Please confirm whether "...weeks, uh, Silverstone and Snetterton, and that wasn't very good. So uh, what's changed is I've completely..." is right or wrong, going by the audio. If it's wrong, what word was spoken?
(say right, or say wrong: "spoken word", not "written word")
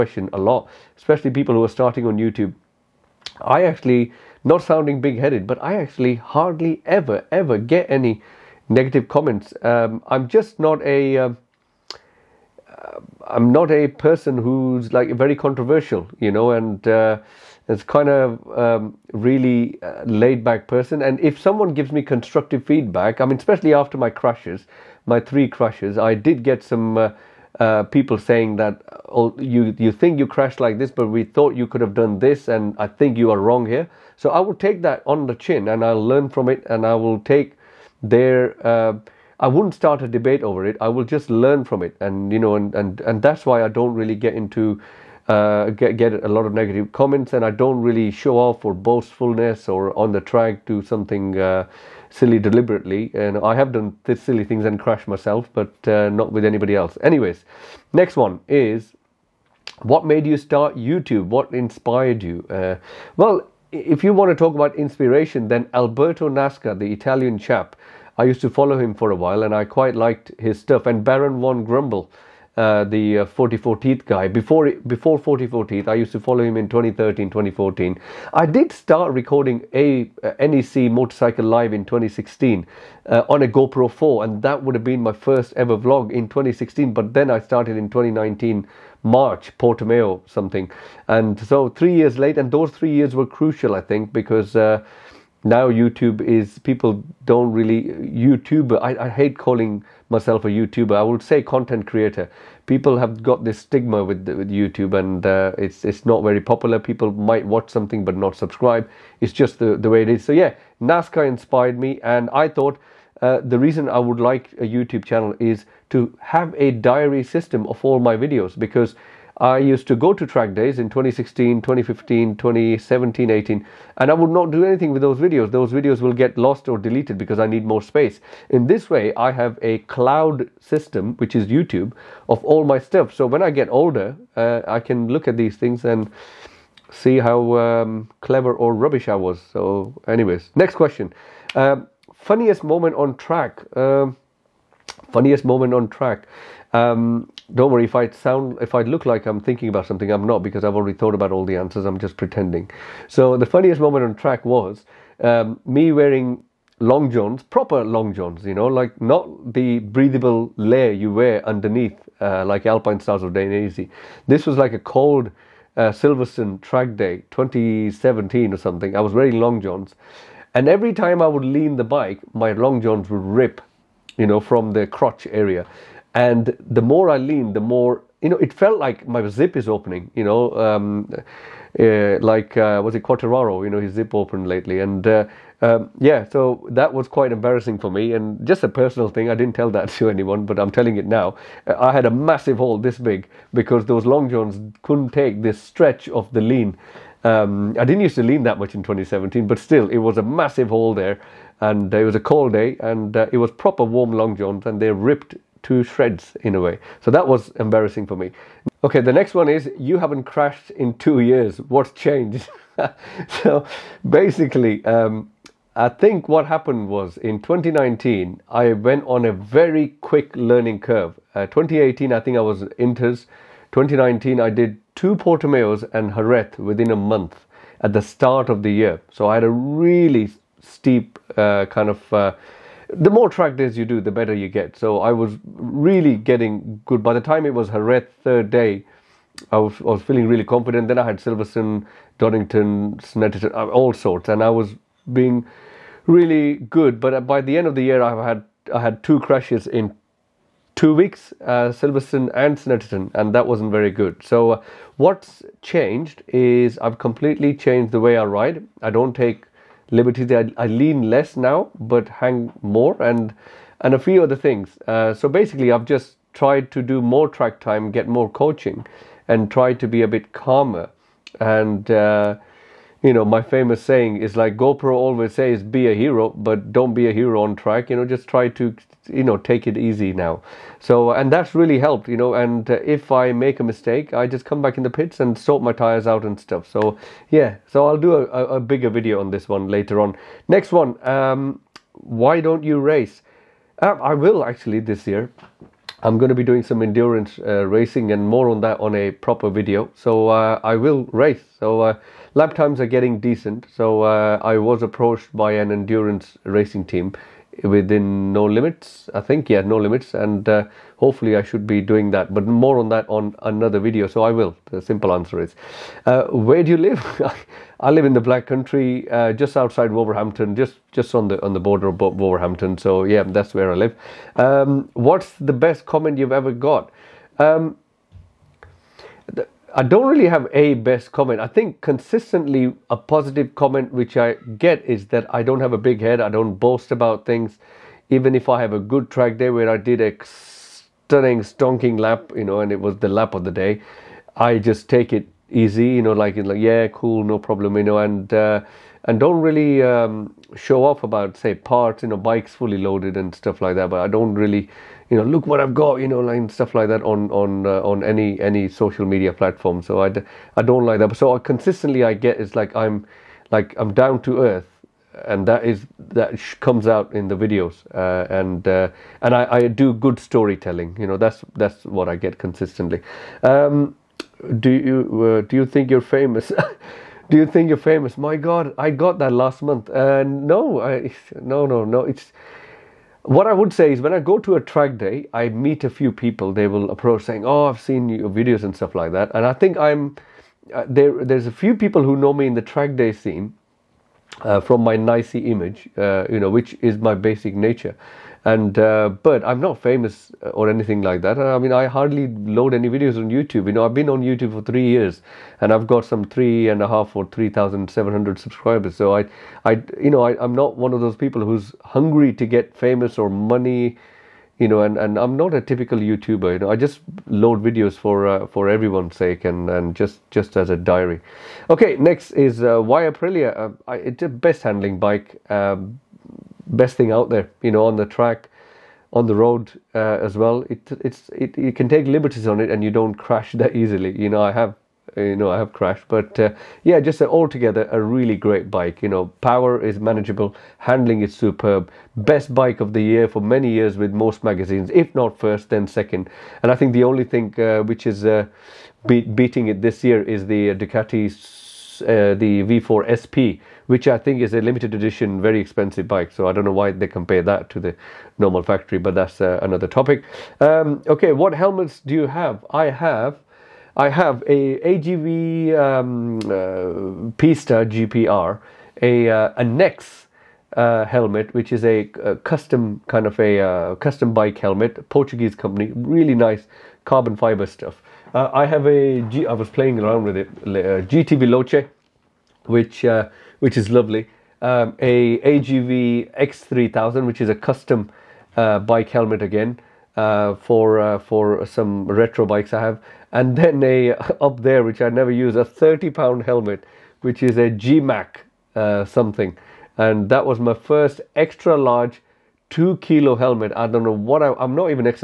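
right.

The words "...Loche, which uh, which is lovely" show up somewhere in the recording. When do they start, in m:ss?
8:01.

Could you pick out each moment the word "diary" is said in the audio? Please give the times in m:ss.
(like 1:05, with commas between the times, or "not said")
1:56, 7:00.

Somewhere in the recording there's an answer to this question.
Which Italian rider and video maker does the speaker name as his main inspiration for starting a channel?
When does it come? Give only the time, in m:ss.
1:05.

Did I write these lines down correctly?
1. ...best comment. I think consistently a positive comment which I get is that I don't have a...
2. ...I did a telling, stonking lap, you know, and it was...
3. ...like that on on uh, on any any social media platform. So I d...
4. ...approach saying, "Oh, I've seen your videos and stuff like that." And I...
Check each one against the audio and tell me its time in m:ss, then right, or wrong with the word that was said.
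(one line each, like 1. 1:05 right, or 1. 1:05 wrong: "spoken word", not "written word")
1. 5:30 right
2. 5:39 wrong: "stunning", not "telling"
3. 5:56 right
4. 6:26 right.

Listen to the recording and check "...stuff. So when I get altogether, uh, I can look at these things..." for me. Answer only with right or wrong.
wrong.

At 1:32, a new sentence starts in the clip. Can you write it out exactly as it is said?
And those three years were crucial, I think, because.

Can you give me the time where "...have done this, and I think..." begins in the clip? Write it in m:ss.
0:31.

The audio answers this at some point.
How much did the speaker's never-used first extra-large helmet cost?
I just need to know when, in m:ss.
8:15.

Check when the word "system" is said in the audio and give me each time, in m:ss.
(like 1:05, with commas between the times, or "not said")
1:57, 2:10.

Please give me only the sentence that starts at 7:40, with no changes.
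Um, okay, what helmets do you have?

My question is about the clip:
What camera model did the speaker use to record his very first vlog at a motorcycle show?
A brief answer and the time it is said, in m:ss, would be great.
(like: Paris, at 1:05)
GoPro 4, at 1:23.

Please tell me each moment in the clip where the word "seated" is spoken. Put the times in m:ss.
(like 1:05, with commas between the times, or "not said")
not said.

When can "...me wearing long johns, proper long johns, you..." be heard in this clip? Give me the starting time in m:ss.
2:35.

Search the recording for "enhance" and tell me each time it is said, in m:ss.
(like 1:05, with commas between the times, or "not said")
not said.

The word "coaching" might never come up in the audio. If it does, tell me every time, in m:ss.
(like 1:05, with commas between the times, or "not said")
4:28.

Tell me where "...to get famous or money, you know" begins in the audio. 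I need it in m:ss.
6:52.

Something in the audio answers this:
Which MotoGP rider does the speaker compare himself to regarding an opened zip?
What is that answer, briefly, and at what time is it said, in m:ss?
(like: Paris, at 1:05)
Quartararo, at 3:03.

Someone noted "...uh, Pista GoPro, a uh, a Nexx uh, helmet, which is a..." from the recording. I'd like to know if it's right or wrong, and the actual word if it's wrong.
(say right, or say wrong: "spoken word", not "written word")
wrong: "GPR", not "GoPro".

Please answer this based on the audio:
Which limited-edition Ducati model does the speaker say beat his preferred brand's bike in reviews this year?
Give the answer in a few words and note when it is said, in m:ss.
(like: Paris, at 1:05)
V4 SP, at 7:32.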